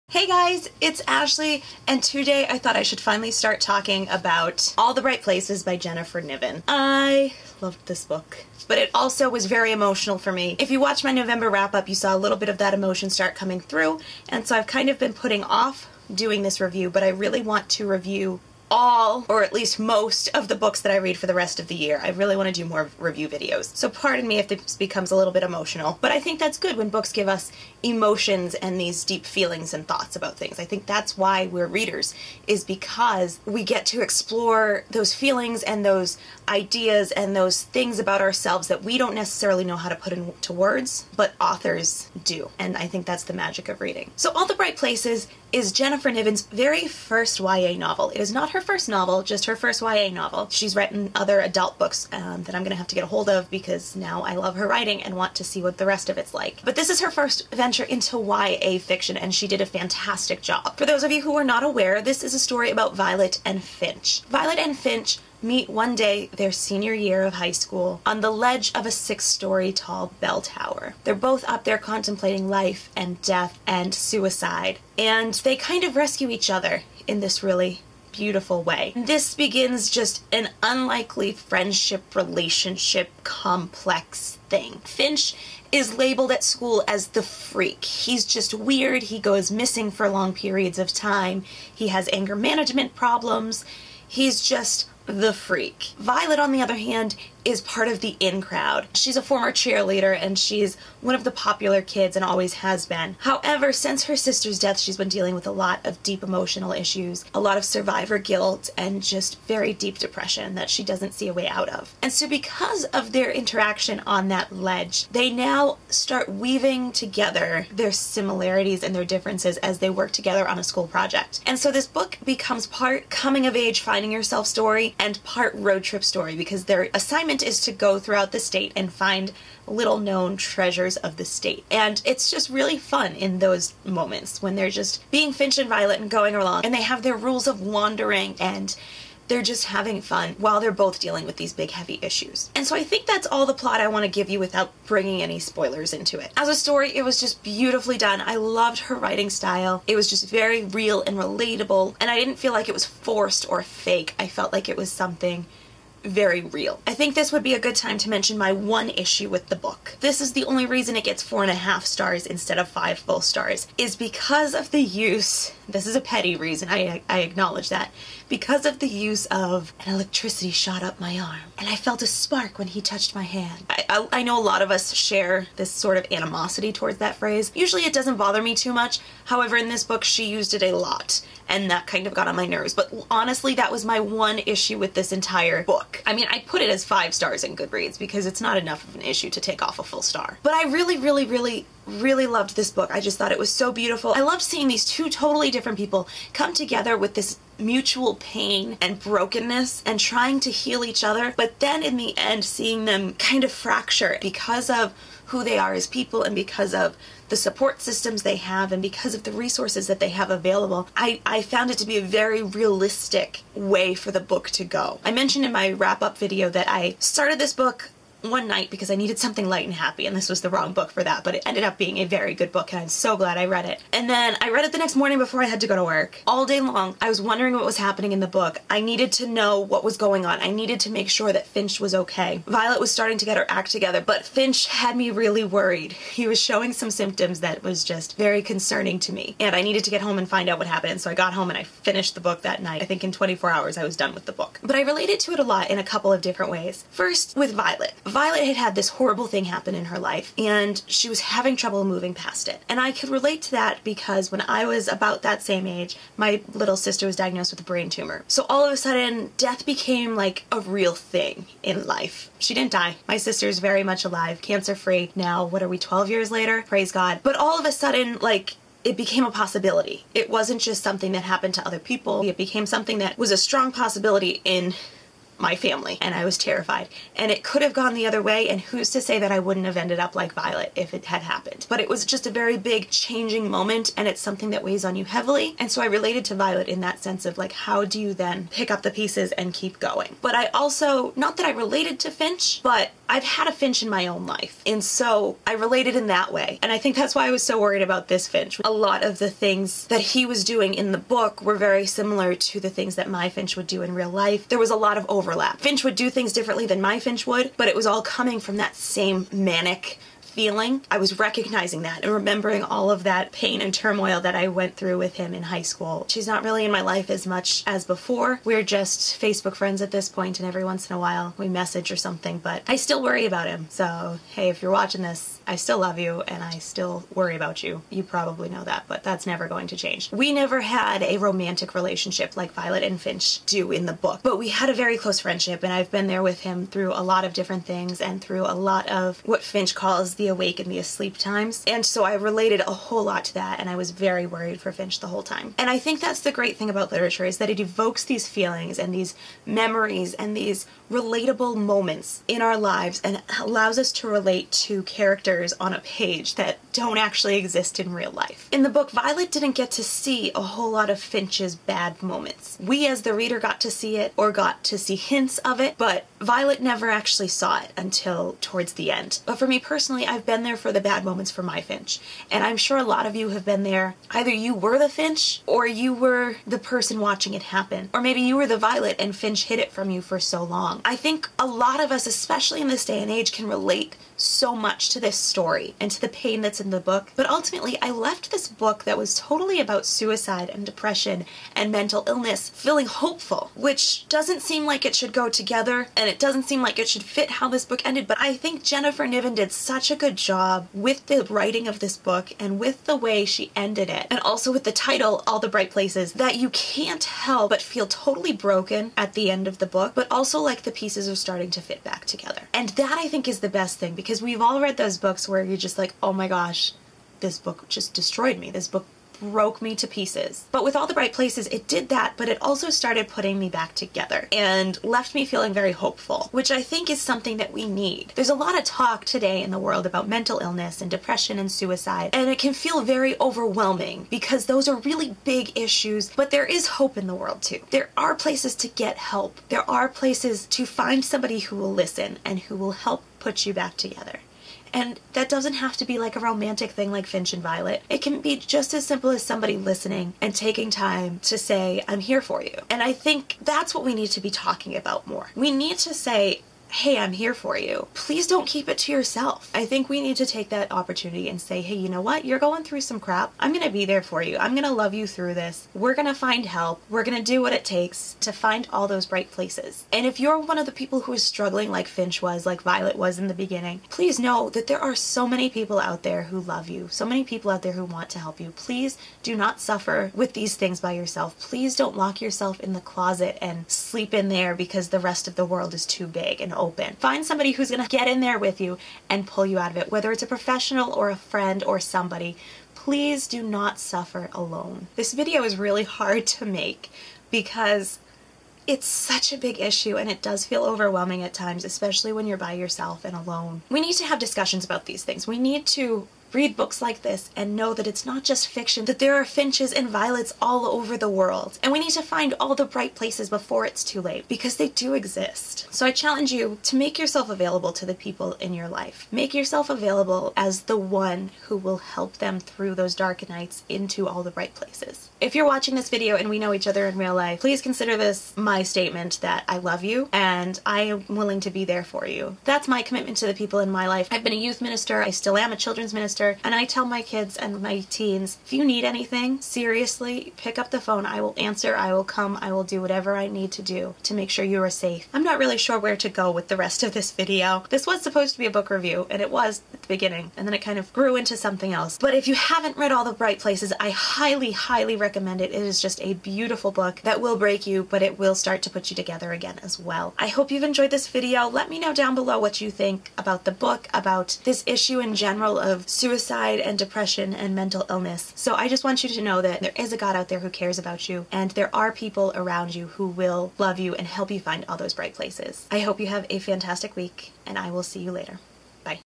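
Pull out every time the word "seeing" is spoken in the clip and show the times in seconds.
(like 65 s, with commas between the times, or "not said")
194 s, 202 s.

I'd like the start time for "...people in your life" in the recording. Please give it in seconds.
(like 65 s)
517 s.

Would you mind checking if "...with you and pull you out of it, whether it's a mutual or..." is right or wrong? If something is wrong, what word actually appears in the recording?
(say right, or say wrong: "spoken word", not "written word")
wrong: "professional", not "mutual".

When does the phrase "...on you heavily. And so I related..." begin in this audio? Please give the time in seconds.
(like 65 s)
284 s.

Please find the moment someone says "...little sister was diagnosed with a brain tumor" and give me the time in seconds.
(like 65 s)
256 s.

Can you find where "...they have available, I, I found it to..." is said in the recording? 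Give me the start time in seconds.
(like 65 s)
210 s.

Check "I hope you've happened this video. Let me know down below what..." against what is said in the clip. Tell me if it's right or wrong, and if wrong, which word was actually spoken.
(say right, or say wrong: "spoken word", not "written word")
wrong: "enjoyed", not "happened".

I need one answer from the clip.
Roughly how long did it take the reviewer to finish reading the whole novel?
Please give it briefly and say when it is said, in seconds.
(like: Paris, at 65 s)
24 hours, at 243 s.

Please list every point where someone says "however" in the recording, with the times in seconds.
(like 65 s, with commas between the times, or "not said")
103 s, 179 s.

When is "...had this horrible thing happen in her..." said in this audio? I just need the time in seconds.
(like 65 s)
248 s.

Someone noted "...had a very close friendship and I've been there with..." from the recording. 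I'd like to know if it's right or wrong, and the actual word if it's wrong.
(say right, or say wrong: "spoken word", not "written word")
right.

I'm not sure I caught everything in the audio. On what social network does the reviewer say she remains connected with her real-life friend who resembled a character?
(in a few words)
Facebook.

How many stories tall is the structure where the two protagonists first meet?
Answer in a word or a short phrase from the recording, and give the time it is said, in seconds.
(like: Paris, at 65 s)
6, at 68 s.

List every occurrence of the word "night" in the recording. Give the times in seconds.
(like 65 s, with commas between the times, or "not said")
218 s, 242 s, 523 s.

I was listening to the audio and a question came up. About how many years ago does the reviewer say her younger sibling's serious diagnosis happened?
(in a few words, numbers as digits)
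12 years.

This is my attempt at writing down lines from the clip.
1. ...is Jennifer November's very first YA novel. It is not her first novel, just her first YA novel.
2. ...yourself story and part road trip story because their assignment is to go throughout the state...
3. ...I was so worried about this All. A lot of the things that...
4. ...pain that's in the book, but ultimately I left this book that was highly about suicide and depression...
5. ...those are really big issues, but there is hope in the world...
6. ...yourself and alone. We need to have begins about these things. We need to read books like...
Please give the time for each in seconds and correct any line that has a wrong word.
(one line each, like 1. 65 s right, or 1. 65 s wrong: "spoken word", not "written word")
1. 45 s wrong: "Niven", not "November"
2. 124 s right
3. 297 s wrong: "Finch", not "All"
4. 386 s wrong: "totally", not "highly"
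5. 434 s right
6. 502 s wrong: "discussions", not "begins".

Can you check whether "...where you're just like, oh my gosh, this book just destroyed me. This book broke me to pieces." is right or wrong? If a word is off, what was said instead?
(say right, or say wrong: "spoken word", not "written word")
right.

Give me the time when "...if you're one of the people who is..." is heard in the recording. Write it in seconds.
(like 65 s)
470 s.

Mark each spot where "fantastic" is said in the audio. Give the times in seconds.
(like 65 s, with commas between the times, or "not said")
59 s, 576 s.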